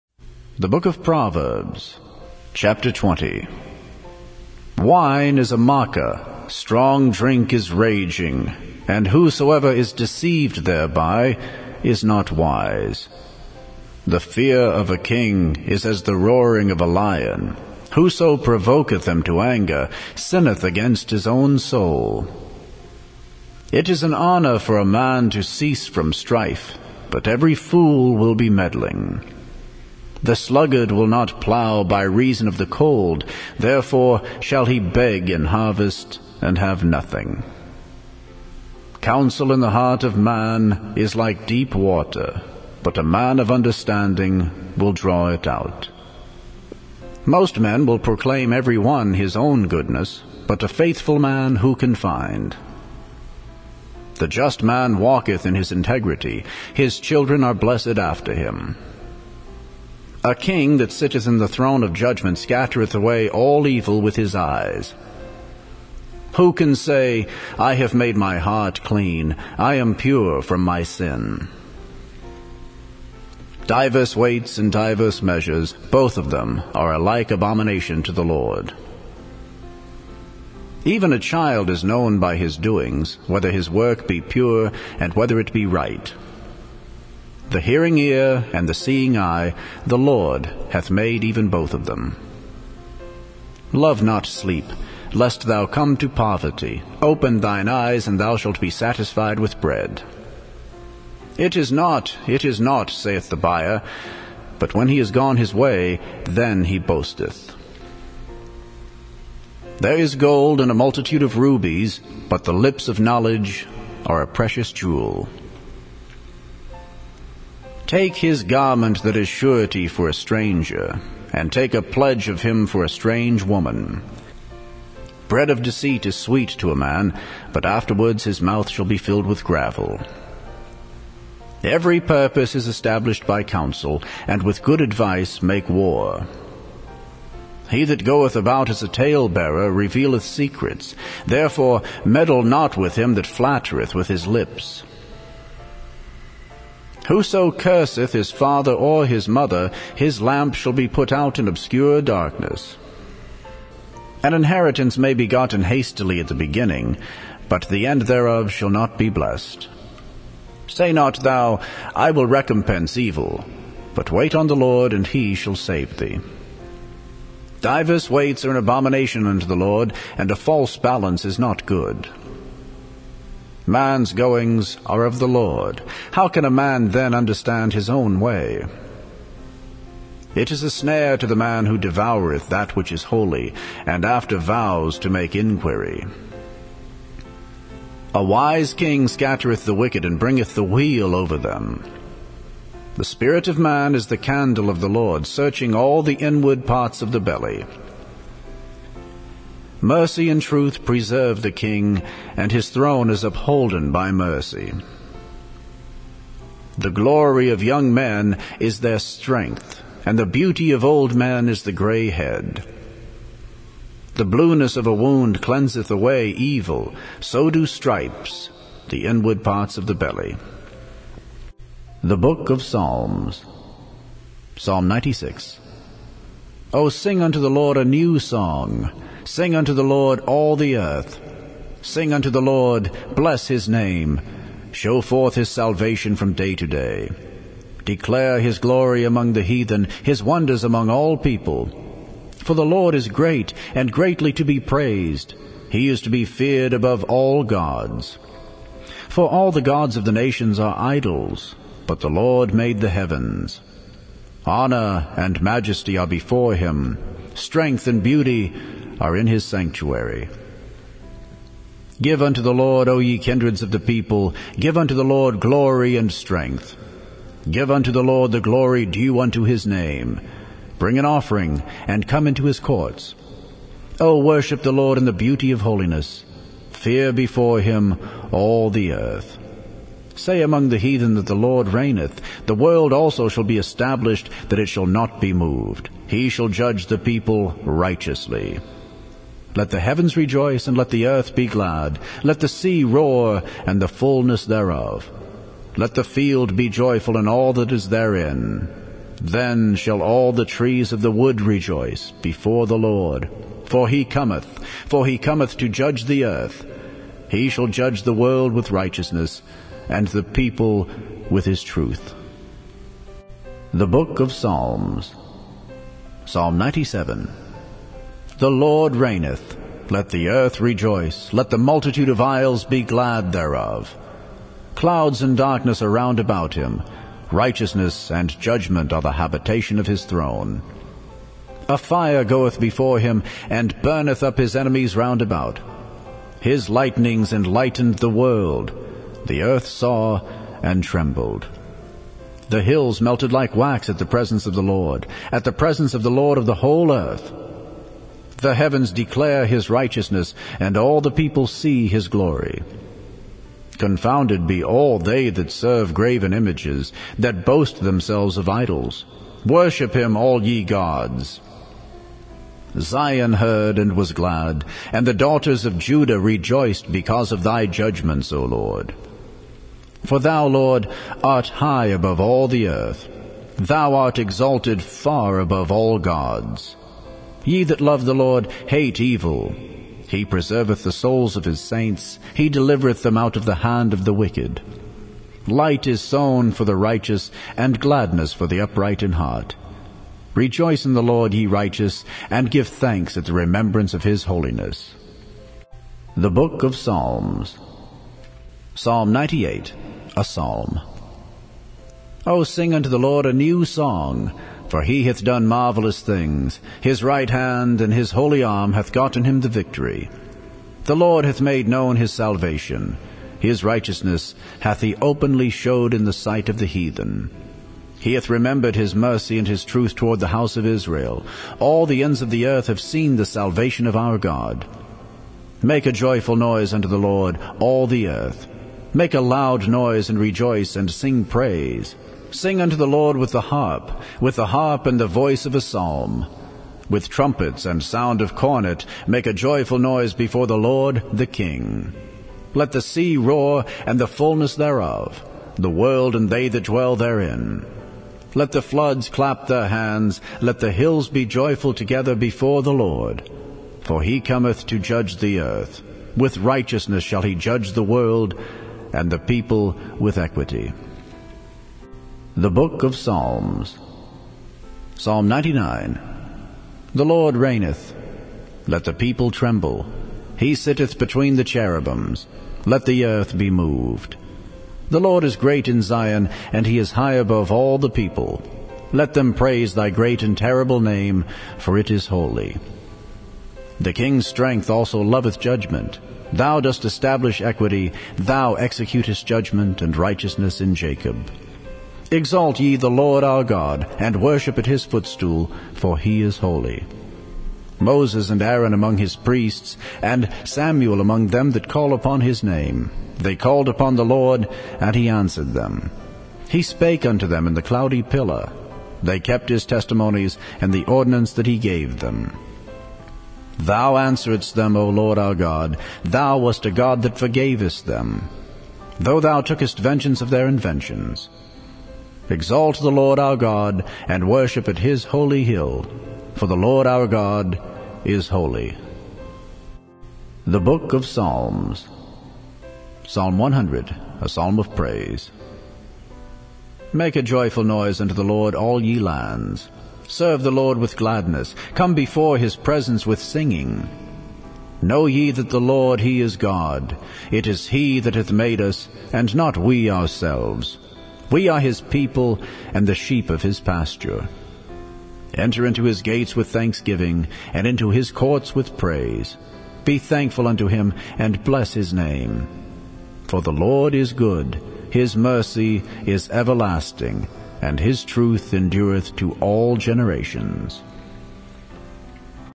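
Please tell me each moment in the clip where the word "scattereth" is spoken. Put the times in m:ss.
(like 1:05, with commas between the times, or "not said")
1:02, 3:09.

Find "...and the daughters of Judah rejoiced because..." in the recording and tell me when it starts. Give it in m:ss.
6:04.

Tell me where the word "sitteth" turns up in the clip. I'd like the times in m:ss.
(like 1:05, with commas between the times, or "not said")
1:00, 7:50.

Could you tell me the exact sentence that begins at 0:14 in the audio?
The fear of a king is as the roaring of a lion.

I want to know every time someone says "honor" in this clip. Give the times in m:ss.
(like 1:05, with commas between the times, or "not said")
0:24, 4:14.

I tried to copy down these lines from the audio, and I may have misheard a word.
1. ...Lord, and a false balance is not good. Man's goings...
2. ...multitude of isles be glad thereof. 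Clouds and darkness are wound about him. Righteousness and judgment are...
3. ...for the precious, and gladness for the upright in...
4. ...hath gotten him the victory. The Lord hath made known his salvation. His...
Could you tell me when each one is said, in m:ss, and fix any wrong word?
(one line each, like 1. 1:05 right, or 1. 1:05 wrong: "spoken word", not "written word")
1. 2:49 right
2. 5:21 wrong: "round", not "wound"
3. 6:26 wrong: "righteous", not "precious"
4. 6:48 right.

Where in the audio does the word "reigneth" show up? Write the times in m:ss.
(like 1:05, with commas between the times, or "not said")
4:41, 5:18, 7:47.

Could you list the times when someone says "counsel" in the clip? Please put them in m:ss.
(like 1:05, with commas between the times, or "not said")
0:39, 2:13.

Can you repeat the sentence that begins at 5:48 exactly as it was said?
The heavens declare his righteousness, and all the people see his glory.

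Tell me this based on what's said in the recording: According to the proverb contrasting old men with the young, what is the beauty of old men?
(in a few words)
grey head.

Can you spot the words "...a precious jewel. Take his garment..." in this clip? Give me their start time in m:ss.
1:54.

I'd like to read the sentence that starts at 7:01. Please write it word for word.
All the ends of the earth have seen the salvation of our God.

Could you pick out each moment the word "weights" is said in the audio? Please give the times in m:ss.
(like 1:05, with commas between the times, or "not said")
1:14, 2:48.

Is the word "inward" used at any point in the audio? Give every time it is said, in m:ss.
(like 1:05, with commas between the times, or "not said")
3:16, 3:39.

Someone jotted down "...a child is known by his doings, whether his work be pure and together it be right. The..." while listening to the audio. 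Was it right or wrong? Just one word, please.
wrong.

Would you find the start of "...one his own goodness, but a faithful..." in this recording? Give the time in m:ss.
0:48.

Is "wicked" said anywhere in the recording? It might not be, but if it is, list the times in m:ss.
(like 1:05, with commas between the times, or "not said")
3:09, 6:24.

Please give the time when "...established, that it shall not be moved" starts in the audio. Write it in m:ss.
4:43.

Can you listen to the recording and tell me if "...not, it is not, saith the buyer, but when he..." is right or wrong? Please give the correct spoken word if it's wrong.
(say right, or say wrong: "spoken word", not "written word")
right.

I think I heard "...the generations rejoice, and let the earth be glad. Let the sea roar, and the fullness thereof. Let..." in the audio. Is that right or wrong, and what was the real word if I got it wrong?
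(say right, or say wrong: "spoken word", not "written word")
wrong: "heavens", not "generations".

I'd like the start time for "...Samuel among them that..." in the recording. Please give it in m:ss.
8:20.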